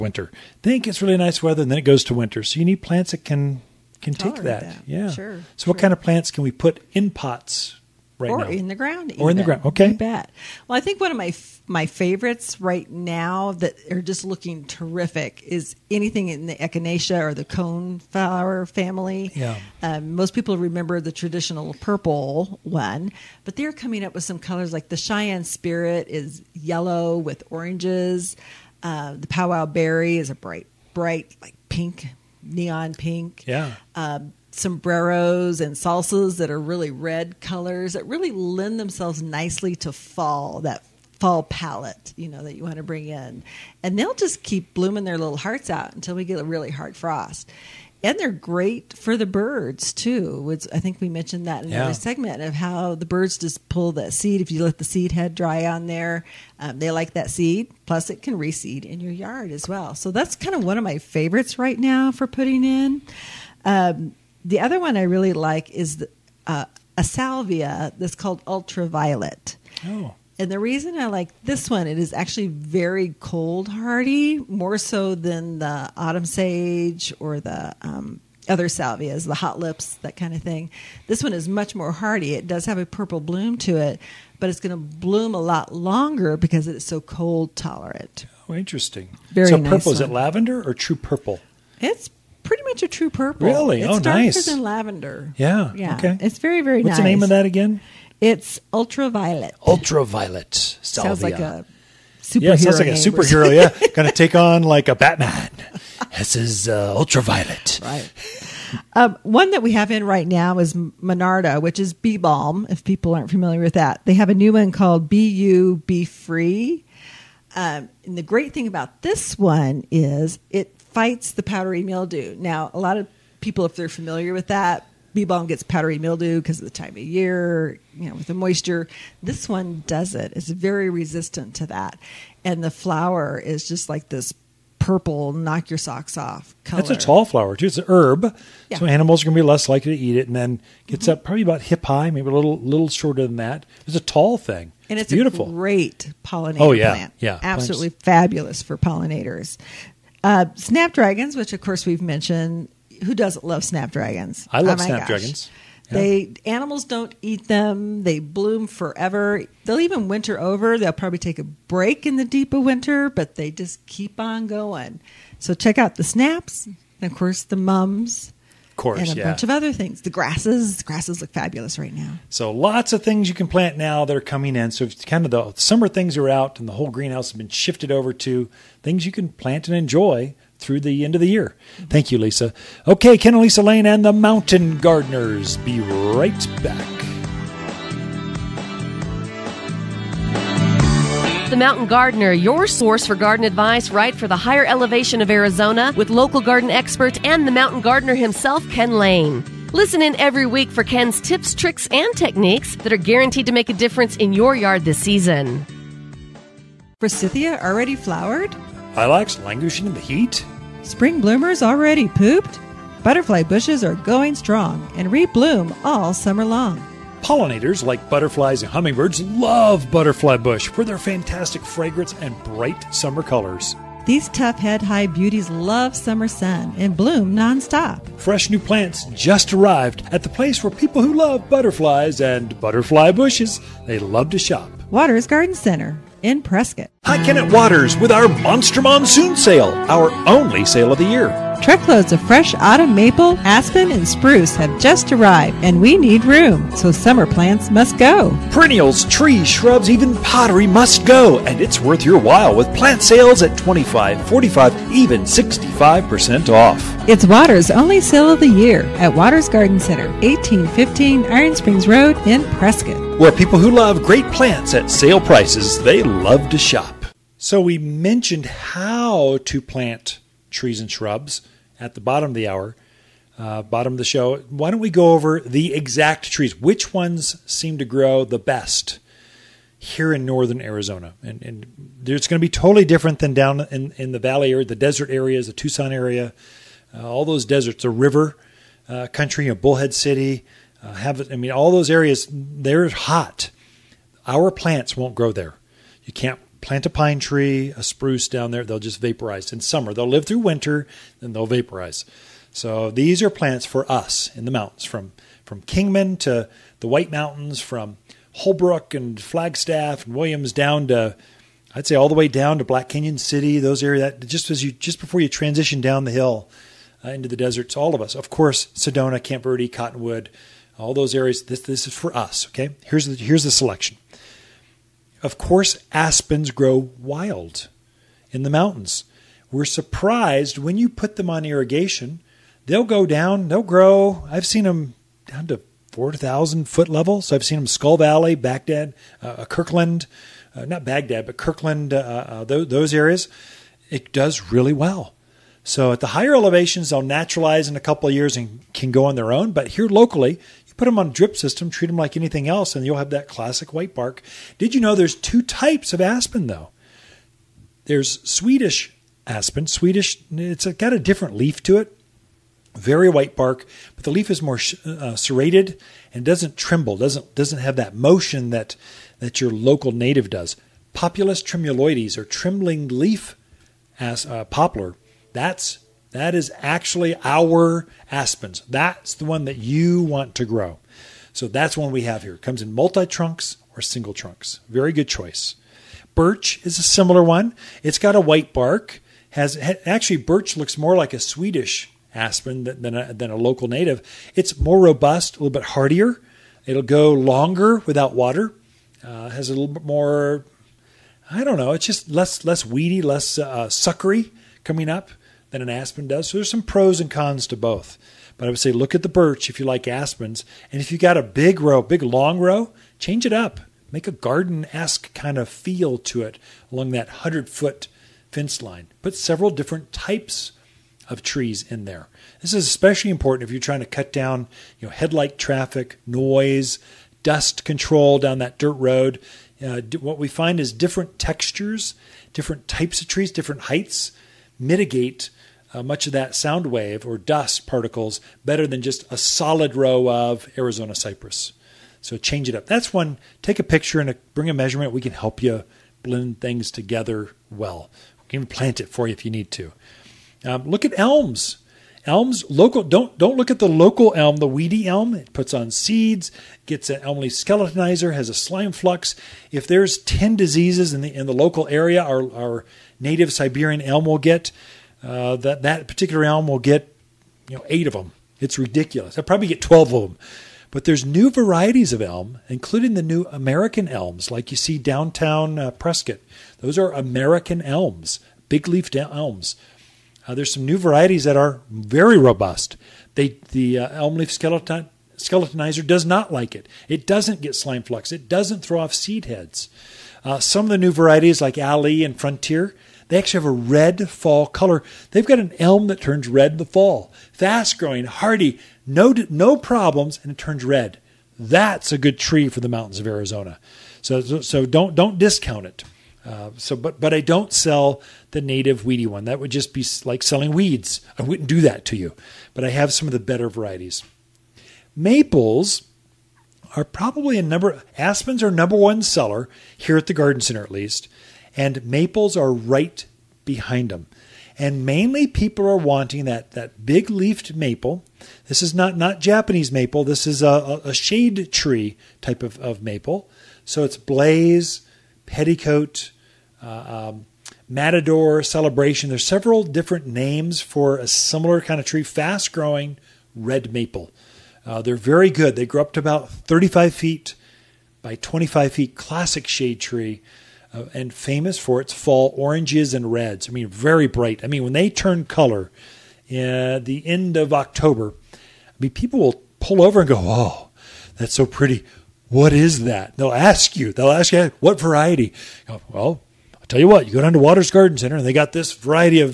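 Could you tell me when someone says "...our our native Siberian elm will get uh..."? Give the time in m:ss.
7:42.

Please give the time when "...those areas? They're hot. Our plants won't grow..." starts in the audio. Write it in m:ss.
4:51.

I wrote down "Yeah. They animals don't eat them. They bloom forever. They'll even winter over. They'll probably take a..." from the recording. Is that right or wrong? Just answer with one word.
right.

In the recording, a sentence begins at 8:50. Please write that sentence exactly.
This is a, a shade tree type of, of maple.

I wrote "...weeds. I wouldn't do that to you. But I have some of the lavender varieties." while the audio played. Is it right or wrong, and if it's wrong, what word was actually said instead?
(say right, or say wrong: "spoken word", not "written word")
wrong: "better", not "lavender".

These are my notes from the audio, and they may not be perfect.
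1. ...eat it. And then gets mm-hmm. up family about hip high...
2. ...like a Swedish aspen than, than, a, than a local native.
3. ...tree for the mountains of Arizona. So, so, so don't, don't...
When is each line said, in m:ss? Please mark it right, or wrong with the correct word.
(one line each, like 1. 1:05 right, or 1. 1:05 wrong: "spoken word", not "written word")
1. 2:20 wrong: "probably", not "family"
2. 6:30 right
3. 8:22 right.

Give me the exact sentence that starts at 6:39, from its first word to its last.
Uh, has a little bit more.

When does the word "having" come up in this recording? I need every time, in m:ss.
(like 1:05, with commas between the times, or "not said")
not said.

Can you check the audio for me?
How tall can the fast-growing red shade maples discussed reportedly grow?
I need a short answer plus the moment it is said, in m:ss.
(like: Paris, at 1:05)
35 feet, at 9:06.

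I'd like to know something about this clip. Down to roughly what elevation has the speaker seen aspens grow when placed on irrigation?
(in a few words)
4,000 feet.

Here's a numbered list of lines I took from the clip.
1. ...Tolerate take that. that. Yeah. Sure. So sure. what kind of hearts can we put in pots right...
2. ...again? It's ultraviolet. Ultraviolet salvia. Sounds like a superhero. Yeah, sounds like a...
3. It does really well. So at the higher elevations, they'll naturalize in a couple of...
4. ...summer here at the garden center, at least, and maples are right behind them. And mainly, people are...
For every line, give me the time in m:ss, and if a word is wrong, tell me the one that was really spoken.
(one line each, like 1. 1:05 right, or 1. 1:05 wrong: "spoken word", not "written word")
1. 0:04 wrong: "plants", not "hearts"
2. 1:37 right
3. 5:43 right
4. 8:39 wrong: "seller", not "summer".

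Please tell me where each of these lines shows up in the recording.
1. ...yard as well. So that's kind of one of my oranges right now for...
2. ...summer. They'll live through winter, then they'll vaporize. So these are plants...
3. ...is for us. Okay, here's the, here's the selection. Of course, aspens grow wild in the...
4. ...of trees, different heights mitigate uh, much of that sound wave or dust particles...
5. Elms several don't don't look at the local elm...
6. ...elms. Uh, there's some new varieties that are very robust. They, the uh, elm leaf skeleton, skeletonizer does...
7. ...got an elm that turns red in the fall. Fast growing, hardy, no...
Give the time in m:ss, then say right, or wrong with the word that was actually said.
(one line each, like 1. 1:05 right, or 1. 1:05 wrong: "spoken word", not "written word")
1. 0:59 wrong: "favorites", not "oranges"
2. 4:59 right
3. 5:21 right
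4. 7:13 right
5. 7:32 wrong: "local", not "several"
6. 7:58 right
7. 8:15 right.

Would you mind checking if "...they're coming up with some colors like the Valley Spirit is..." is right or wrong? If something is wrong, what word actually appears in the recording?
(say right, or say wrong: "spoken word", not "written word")
wrong: "Cheyenne", not "Valley".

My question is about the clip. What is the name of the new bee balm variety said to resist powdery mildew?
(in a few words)
BU Be Free.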